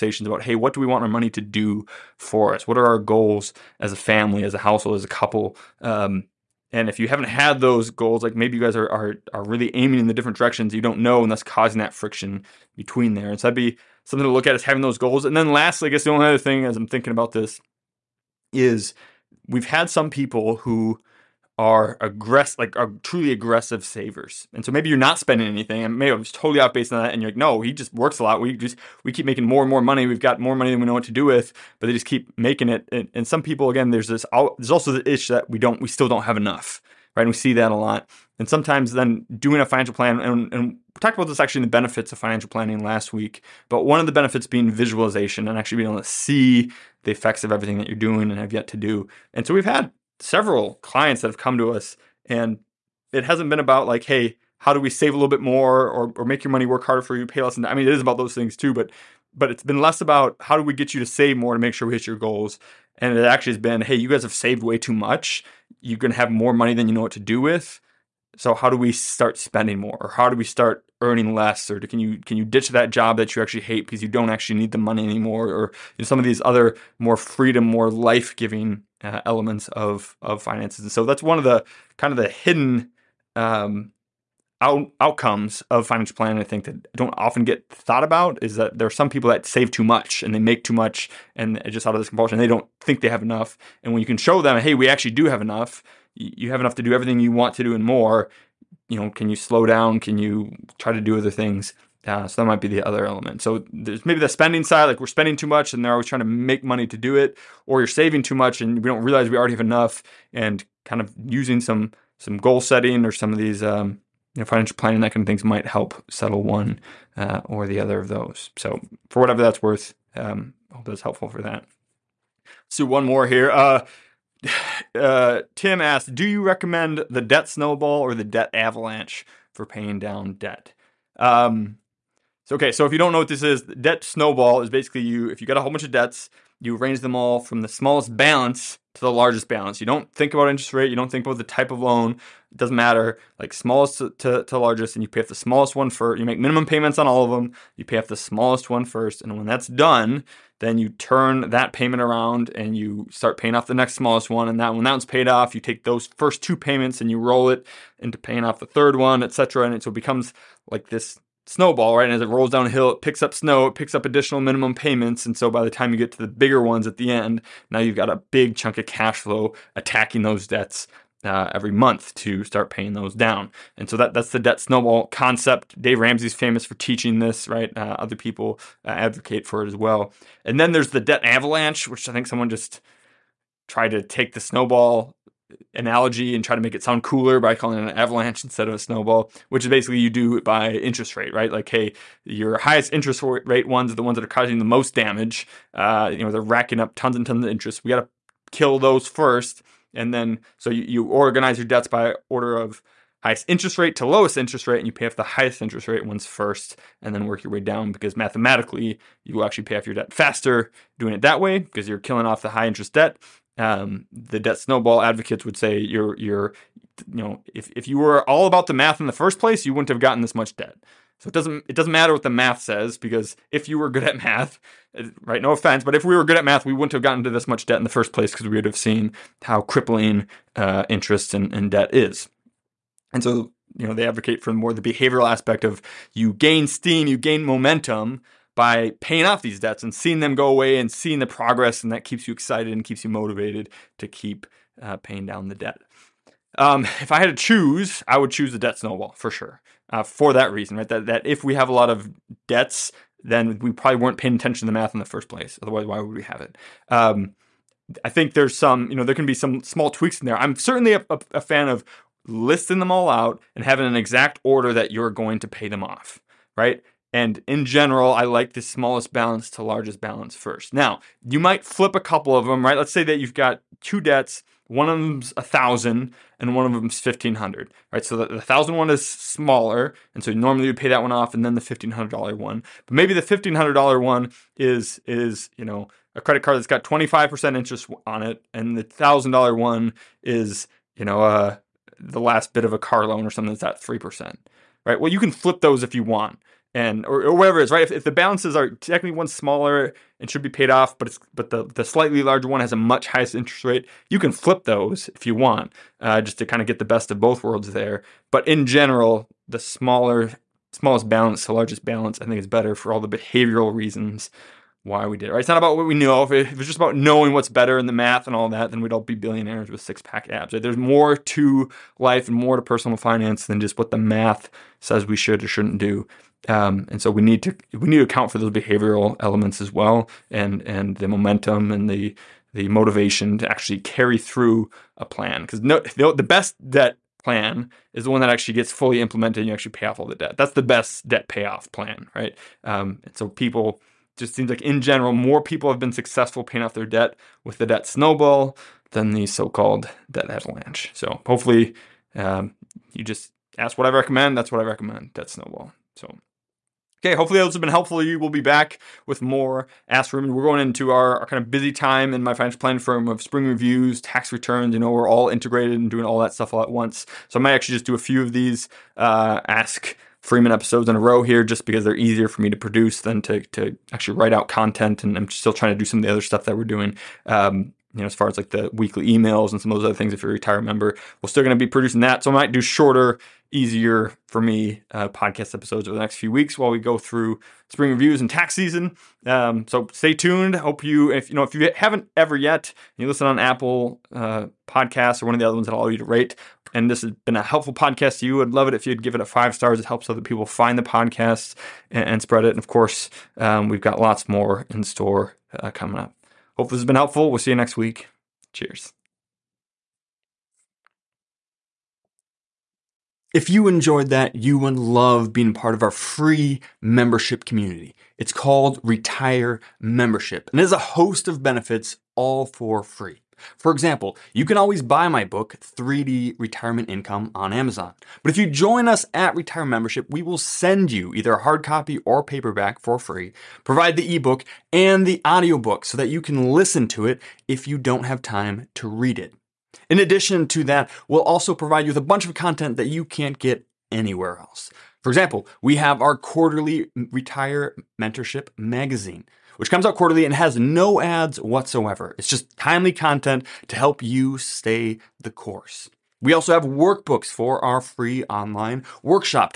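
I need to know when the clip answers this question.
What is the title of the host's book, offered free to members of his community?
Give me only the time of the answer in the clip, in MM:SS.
07:05.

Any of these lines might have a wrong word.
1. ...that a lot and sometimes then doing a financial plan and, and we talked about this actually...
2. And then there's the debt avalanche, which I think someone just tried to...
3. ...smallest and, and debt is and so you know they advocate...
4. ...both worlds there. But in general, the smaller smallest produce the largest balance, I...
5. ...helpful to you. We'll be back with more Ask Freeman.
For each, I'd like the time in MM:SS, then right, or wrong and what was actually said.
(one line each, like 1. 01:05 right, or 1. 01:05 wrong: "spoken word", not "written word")
1. 00:37 right
2. 03:00 right
3. 03:50 wrong: "interest", not "smallest"
4. 05:07 wrong: "balance", not "produce"
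5. 05:57 right.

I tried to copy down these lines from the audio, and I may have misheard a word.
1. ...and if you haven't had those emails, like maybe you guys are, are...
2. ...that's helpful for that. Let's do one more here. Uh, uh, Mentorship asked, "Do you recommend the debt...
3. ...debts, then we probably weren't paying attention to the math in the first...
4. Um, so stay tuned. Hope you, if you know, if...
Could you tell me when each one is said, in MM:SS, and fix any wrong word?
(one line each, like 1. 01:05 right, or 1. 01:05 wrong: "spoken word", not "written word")
1. 00:06 wrong: "goals", not "emails"
2. 02:00 wrong: "Tim", not "Mentorship"
3. 04:12 right
4. 06:29 right.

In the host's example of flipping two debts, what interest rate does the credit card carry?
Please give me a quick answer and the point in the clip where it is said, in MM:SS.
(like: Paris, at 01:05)
25 percent, at 04:46.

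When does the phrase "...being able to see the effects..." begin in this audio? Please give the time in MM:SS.
00:45.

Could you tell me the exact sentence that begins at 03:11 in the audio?
Like, hey, your highest interest rate ones are the ones that are causing the most damage.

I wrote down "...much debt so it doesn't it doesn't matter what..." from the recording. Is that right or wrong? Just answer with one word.
right.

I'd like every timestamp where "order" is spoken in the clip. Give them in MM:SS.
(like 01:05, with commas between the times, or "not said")
03:22, 04:24.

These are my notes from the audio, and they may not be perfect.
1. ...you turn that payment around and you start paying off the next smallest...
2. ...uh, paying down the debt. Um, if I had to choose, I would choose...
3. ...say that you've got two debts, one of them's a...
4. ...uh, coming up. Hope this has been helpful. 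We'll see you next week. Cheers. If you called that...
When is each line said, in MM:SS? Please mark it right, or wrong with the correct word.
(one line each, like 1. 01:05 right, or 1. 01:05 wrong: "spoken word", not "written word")
1. 02:30 right
2. 04:04 right
3. 04:32 right
4. 06:45 wrong: "enjoyed", not "called".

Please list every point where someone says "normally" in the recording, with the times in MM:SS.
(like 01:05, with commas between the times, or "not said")
04:40.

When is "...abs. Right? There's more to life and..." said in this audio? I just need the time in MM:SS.
05:20.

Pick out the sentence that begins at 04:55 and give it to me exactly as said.
Well, you can flip those if you want and or, or whatever it is, right?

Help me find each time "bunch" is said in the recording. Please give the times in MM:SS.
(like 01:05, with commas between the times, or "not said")
02:15, 07:22.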